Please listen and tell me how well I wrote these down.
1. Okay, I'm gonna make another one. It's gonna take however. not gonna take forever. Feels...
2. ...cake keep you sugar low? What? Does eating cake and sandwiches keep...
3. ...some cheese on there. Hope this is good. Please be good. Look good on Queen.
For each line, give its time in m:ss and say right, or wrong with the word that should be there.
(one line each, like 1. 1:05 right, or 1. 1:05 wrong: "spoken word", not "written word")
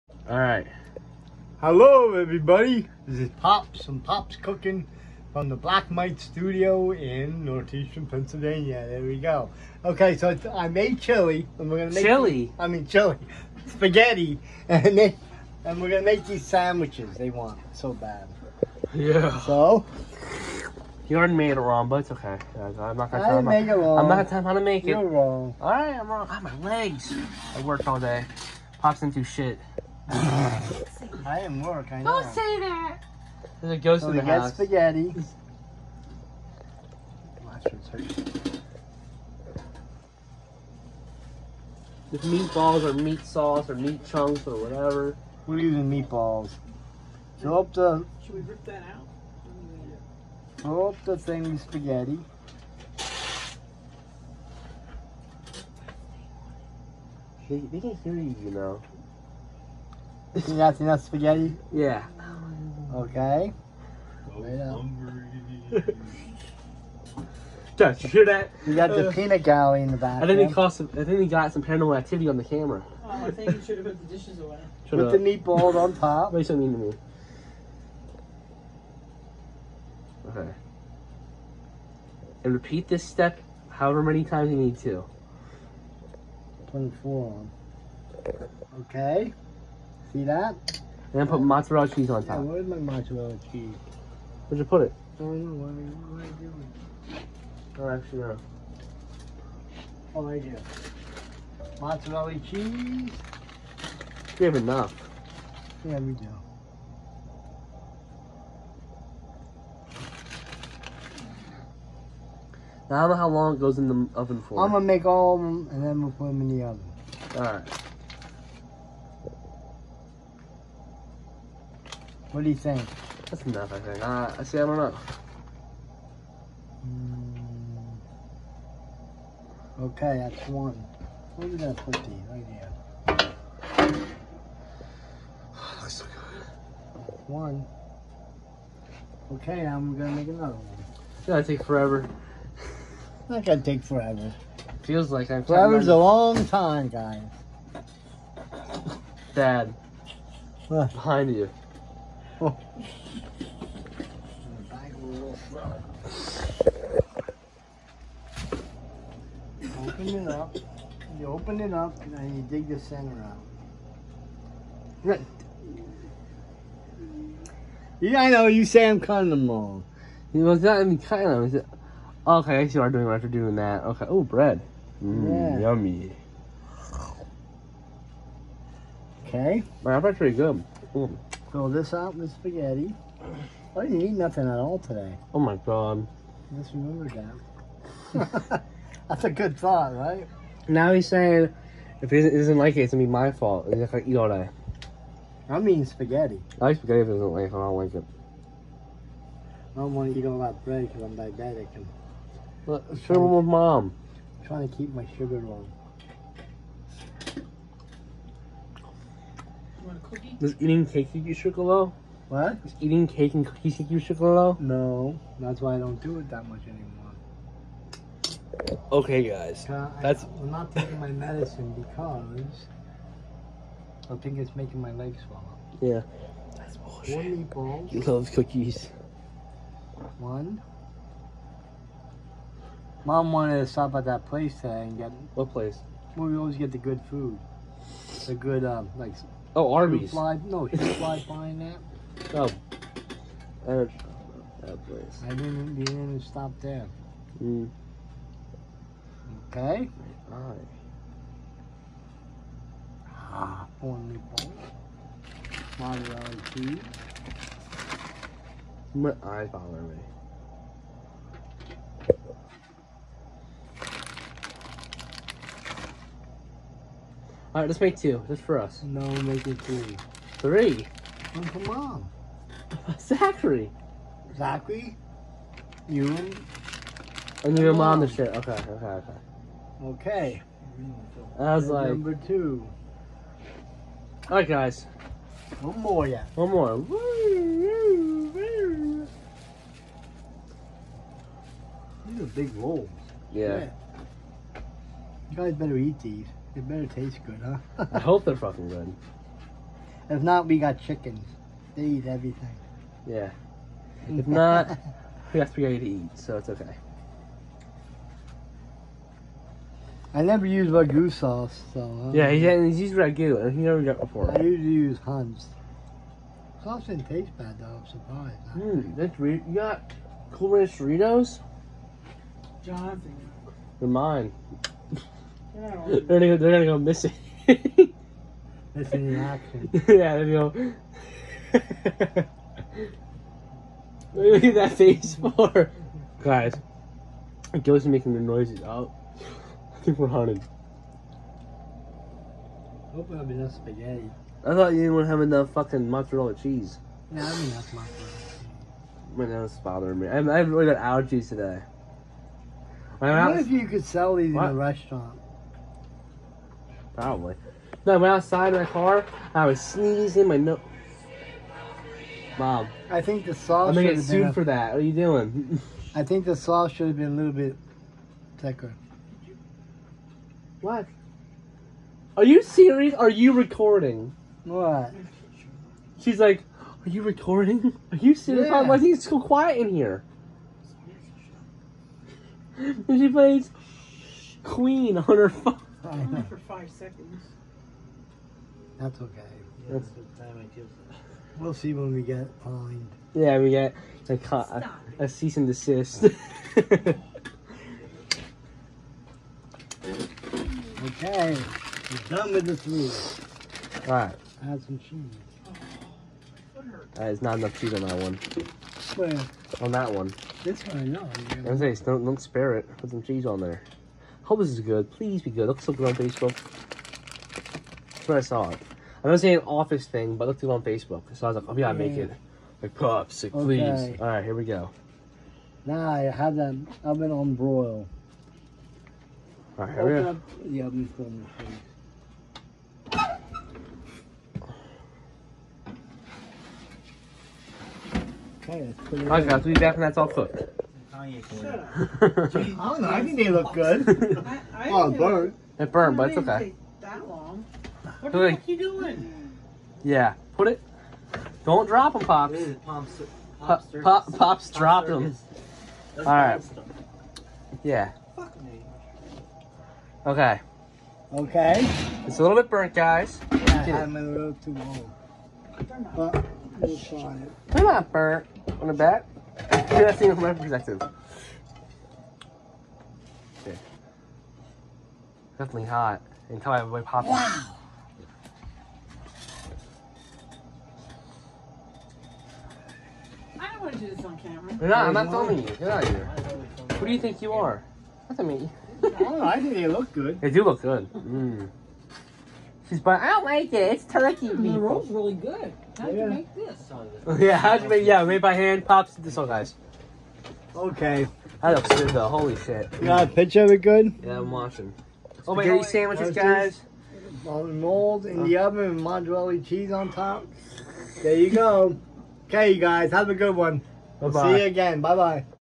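1. 2:19 wrong: "forever", not "however"
2. 3:30 wrong: "cookies", not "sandwiches"
3. 6:52 wrong: "Facebook", not "Queen".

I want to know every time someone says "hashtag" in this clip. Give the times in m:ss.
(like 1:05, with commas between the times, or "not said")
not said.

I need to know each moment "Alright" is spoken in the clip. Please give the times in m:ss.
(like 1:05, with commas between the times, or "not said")
1:57, 6:43.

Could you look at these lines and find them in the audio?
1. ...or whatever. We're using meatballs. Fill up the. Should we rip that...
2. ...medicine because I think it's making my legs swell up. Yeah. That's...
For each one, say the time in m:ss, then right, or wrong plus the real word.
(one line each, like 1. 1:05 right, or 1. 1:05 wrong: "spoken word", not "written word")
1. 0:44 right
2. 3:41 right.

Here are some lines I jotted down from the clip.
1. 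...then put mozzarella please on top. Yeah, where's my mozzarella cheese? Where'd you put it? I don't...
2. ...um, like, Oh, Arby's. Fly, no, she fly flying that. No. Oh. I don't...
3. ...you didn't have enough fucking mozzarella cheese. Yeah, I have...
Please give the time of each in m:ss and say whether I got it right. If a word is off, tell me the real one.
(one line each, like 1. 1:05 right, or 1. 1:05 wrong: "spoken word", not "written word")
1. 1:31 wrong: "cheese", not "please"
2. 3:58 right
3. 5:44 right.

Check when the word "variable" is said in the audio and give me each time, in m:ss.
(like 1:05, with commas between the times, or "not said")
not said.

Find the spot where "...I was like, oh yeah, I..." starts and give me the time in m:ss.
7:01.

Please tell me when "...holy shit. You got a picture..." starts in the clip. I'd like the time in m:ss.
8:22.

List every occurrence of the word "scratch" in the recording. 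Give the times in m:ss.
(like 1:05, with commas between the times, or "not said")
not said.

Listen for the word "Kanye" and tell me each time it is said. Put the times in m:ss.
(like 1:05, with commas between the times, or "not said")
7:21.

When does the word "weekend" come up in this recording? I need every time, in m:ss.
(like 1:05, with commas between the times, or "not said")
not said.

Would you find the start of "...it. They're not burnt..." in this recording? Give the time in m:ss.
7:47.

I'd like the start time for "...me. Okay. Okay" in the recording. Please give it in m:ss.
7:38.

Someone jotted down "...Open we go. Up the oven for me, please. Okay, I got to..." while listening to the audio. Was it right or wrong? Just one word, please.
right.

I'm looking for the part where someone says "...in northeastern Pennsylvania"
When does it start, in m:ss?
0:06.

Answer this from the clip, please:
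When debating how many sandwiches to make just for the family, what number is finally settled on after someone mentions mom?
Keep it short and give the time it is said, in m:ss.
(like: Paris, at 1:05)
3, at 4:29.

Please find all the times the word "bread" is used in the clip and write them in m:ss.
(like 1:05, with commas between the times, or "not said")
2:54, 3:20.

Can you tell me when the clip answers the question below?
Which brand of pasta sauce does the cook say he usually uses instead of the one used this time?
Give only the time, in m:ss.
5:14.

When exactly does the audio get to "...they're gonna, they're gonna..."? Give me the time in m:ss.
5:25.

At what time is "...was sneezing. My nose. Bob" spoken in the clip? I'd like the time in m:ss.
5:59.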